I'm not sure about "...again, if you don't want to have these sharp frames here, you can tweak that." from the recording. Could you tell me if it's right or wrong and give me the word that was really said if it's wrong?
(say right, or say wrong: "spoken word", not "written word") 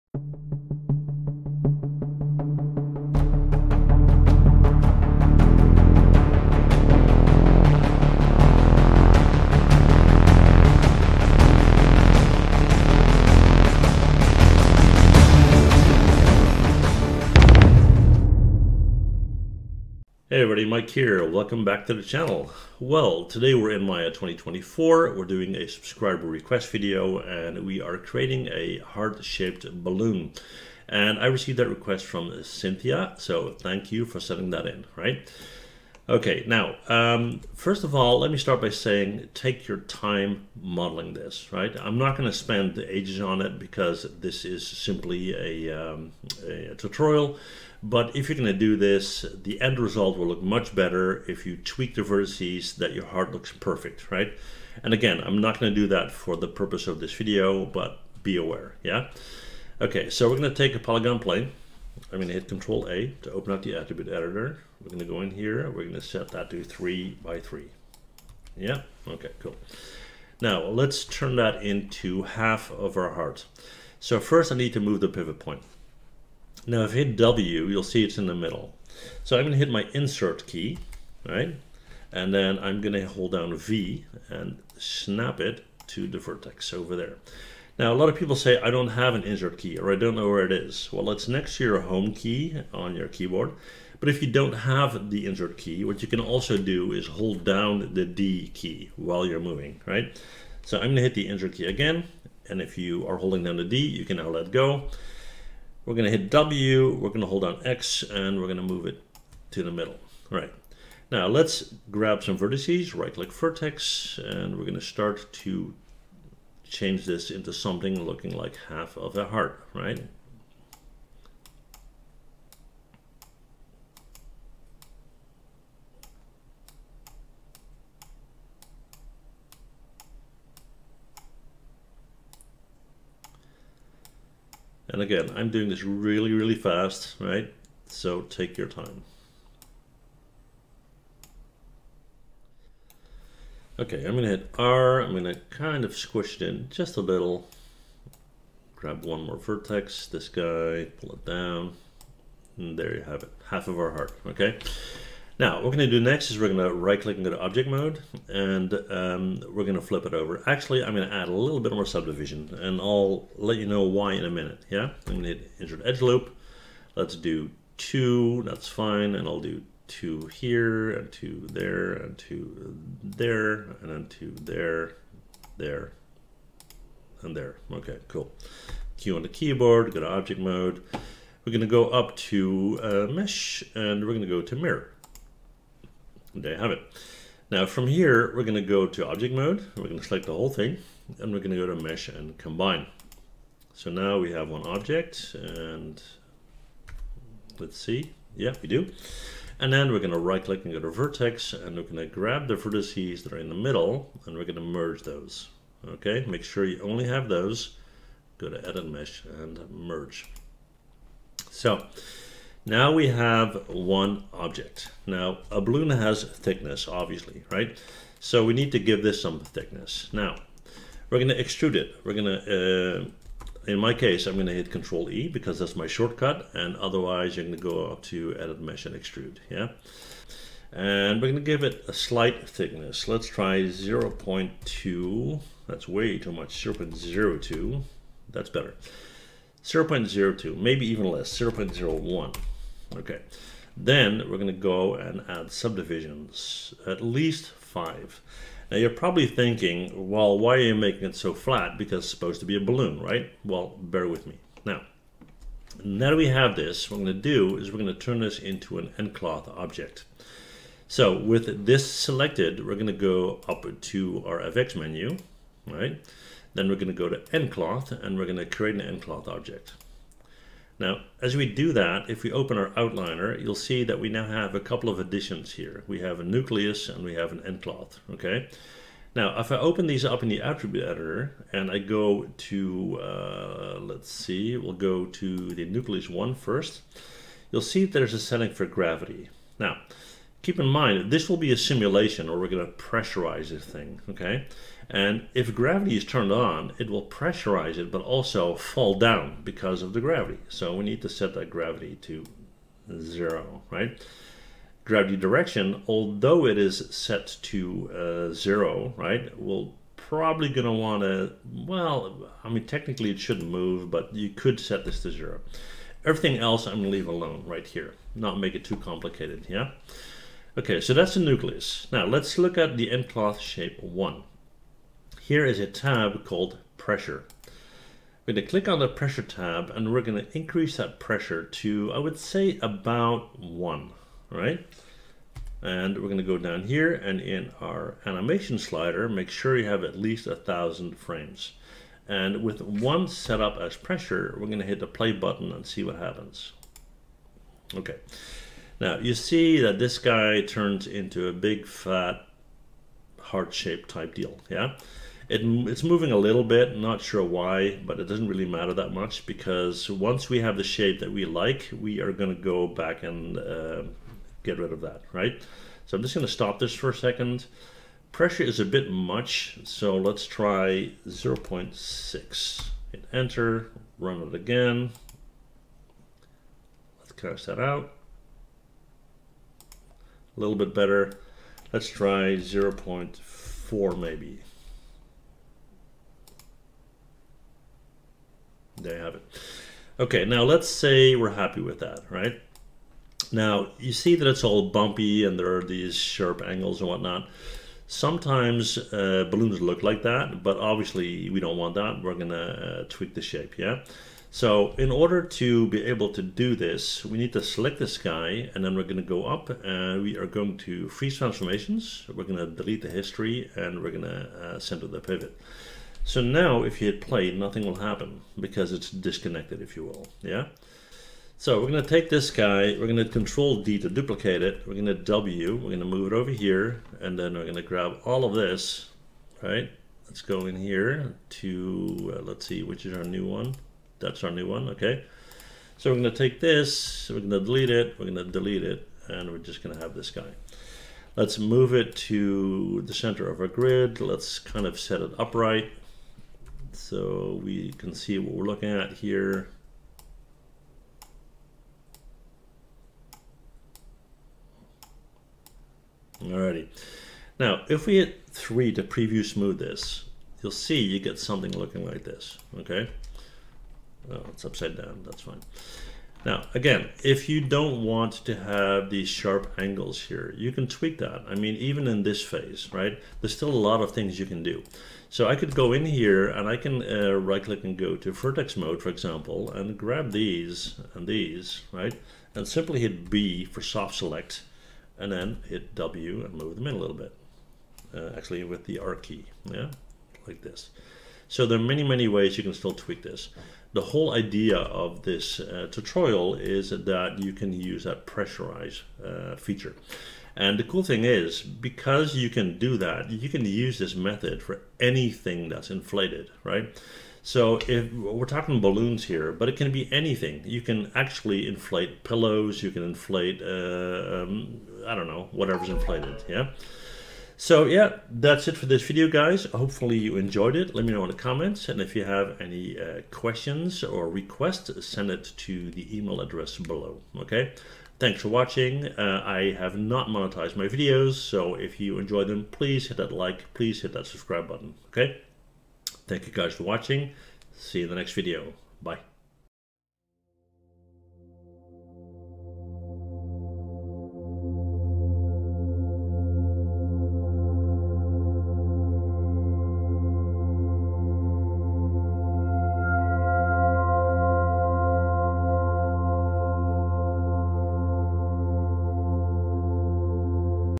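wrong: "angles", not "frames".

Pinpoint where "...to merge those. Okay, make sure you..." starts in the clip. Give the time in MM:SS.
03:24.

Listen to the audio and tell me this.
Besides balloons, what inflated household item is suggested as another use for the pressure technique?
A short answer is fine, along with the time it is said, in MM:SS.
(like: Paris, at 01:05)
pillows, at 08:32.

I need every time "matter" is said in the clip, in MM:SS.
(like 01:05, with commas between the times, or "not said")
05:58.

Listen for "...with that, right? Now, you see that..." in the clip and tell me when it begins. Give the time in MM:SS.
06:31.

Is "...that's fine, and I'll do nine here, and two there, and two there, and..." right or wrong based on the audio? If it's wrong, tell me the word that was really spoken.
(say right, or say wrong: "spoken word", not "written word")
wrong: "two", not "nine".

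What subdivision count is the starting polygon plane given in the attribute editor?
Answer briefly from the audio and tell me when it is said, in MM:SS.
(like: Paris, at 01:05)
3 by 3, at 01:06.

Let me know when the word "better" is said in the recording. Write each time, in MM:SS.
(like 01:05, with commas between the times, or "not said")
00:50, 03:58, 06:20.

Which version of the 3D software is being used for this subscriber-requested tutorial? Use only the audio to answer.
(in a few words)
Maya 2024.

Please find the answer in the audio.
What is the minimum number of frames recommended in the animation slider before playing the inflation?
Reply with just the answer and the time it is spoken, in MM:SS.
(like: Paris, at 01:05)
1000, at 05:40.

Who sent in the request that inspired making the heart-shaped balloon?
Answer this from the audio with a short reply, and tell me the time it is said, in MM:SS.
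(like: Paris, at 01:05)
Cynthia, at 00:32.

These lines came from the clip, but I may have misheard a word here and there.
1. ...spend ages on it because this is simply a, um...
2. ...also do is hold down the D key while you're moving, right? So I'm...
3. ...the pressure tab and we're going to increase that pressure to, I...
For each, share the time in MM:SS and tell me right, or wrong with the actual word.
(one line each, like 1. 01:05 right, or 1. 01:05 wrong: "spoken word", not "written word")
1. 00:42 right
2. 01:36 right
3. 05:28 right.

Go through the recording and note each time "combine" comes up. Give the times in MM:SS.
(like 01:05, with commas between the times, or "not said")
03:12.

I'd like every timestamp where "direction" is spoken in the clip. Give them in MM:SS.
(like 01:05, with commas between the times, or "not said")
05:05.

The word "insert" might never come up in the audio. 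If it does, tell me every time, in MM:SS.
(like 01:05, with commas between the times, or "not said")
01:19, 01:29, 01:35, 01:41, 02:45.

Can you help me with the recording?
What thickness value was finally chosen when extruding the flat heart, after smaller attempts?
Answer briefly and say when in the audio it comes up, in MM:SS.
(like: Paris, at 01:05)
0.01, at 04:01.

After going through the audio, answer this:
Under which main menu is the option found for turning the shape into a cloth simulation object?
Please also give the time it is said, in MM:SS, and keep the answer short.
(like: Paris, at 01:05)
FX, at 04:24.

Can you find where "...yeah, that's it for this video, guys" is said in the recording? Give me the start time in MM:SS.
08:37.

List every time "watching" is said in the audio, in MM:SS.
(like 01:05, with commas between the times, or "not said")
08:48, 08:56.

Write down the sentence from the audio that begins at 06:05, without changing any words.
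So I'm just gonna stop this for a second.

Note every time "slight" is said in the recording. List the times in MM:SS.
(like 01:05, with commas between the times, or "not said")
03:51.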